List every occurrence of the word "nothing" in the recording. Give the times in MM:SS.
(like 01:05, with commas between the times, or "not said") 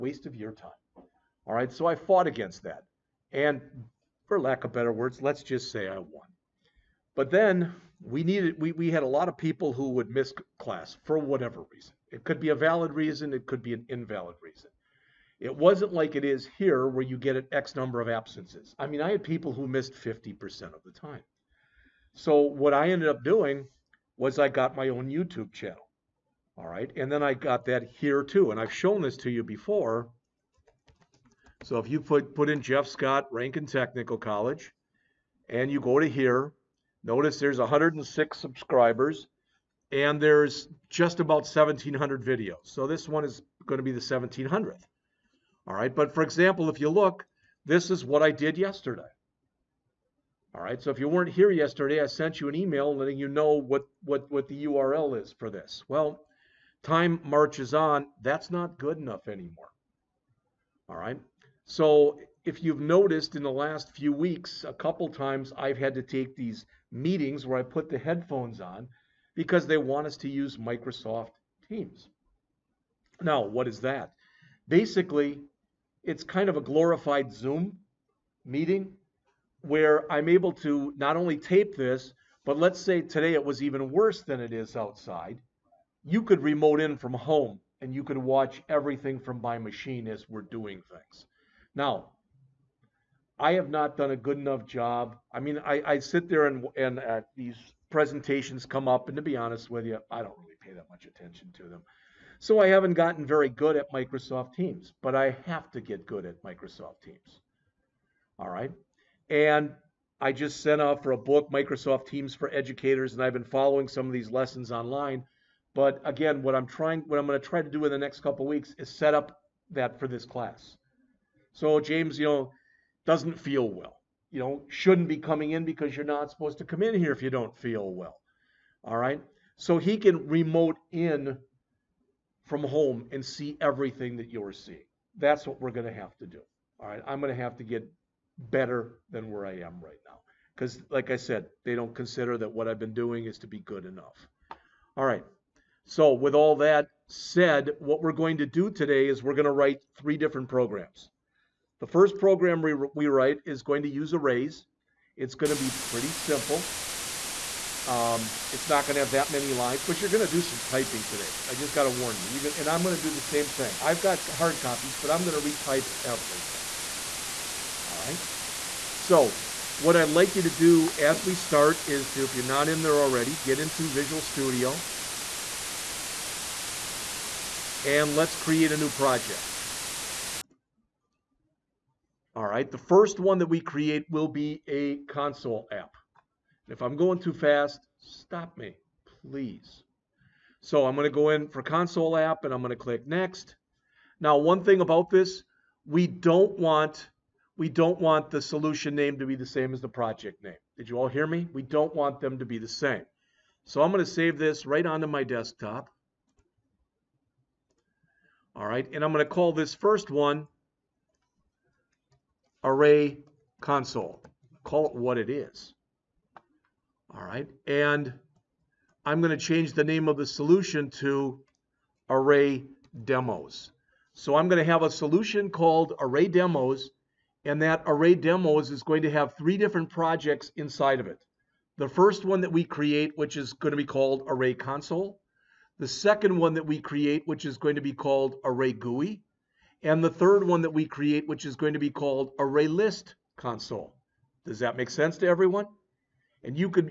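not said.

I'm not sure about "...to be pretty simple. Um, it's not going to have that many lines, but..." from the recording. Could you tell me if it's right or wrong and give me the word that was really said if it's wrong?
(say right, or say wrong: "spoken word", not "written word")
right.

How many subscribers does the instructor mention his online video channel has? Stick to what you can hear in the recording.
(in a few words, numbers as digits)
106.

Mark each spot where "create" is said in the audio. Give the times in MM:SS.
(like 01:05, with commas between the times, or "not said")
02:58, 03:03, 03:52, 03:56, 04:00.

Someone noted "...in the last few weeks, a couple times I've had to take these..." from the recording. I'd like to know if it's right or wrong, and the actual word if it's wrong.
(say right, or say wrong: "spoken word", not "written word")
right.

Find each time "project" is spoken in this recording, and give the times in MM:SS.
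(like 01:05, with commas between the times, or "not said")
02:58, 03:19, 03:49.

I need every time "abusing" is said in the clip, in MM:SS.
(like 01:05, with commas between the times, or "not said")
not said.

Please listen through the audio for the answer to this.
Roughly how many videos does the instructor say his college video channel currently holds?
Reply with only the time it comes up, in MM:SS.
00:41.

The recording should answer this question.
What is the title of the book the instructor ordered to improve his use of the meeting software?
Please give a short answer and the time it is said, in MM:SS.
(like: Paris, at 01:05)
Microsoft Teams for Educators, at 01:51.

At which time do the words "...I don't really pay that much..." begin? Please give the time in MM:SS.
01:40.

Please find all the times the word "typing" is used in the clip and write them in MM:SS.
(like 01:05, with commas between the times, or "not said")
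02:40.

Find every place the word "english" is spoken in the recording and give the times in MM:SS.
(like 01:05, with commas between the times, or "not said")
not said.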